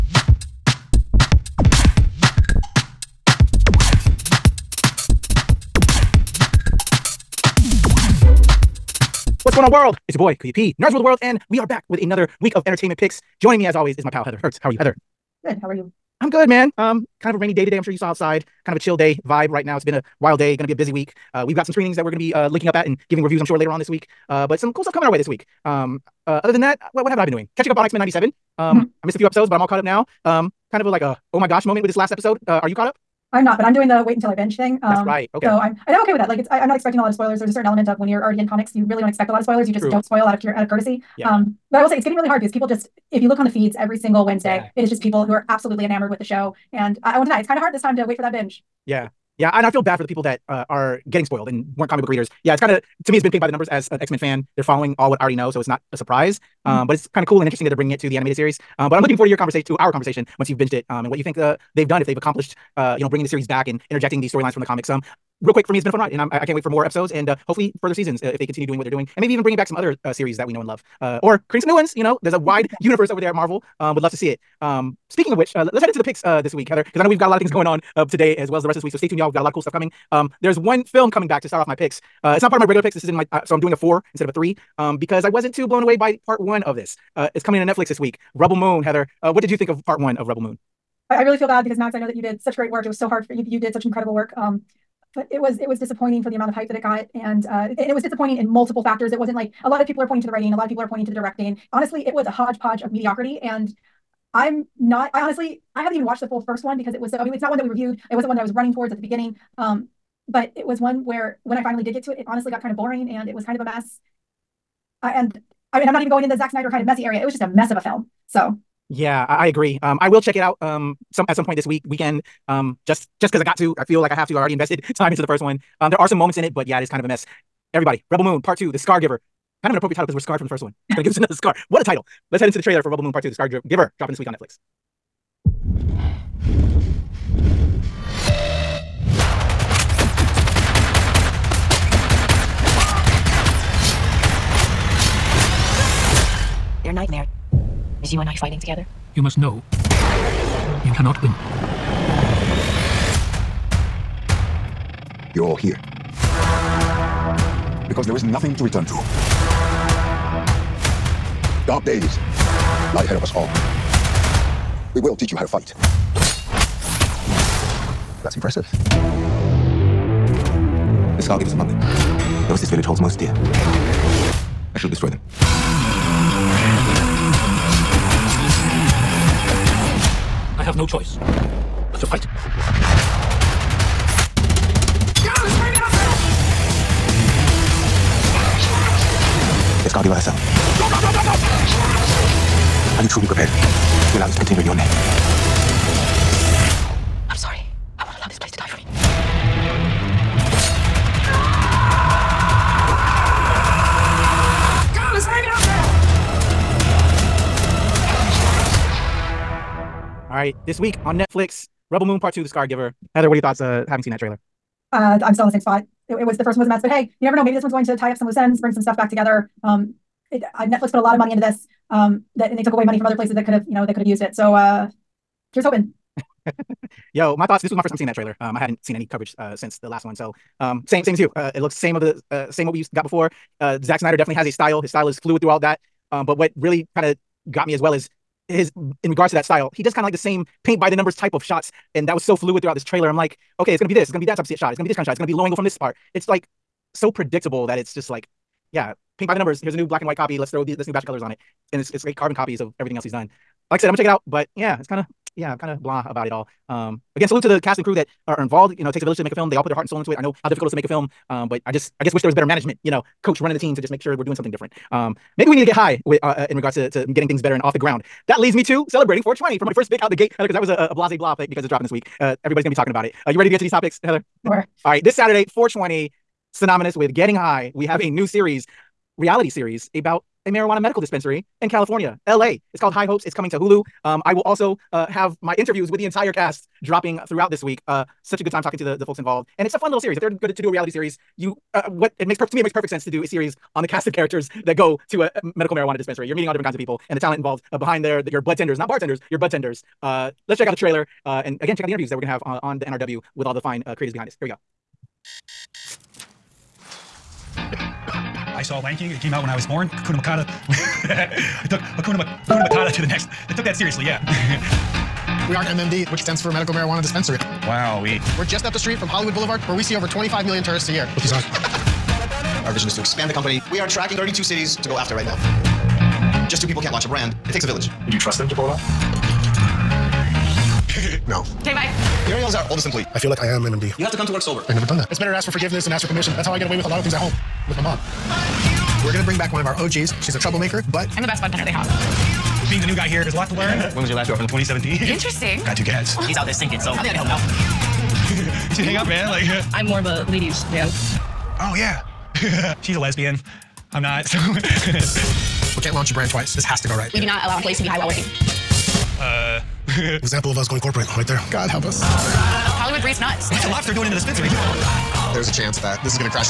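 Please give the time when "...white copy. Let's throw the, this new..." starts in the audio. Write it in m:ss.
4:10.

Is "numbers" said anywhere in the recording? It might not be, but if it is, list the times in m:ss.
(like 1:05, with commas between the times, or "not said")
0:53, 4:00, 4:09.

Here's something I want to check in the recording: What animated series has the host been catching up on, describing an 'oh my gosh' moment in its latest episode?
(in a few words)
X-Men '97.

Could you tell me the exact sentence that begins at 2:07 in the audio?
Everybody, Rebel Moon Part Two, The Scargiver.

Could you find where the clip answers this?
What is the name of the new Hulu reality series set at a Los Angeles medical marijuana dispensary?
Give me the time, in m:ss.
4:42.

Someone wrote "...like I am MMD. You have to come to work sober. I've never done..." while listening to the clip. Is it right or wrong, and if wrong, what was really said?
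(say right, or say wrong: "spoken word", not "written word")
right.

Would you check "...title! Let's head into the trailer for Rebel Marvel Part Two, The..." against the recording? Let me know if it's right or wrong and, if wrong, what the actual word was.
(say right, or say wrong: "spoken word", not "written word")
wrong: "Moon", not "Marvel".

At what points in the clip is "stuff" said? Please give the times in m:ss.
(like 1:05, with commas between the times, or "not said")
0:24, 1:19, 3:38.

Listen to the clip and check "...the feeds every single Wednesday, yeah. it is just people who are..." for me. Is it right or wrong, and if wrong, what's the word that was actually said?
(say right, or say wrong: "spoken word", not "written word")
right.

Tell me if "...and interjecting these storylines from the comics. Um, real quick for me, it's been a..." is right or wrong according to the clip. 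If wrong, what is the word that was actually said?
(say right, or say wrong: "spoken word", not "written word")
right.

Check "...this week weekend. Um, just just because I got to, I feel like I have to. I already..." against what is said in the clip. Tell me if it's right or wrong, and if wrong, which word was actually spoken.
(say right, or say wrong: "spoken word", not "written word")
right.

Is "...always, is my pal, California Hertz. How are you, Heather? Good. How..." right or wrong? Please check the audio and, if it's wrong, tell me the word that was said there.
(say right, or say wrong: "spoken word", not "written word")
wrong: "Heather", not "California".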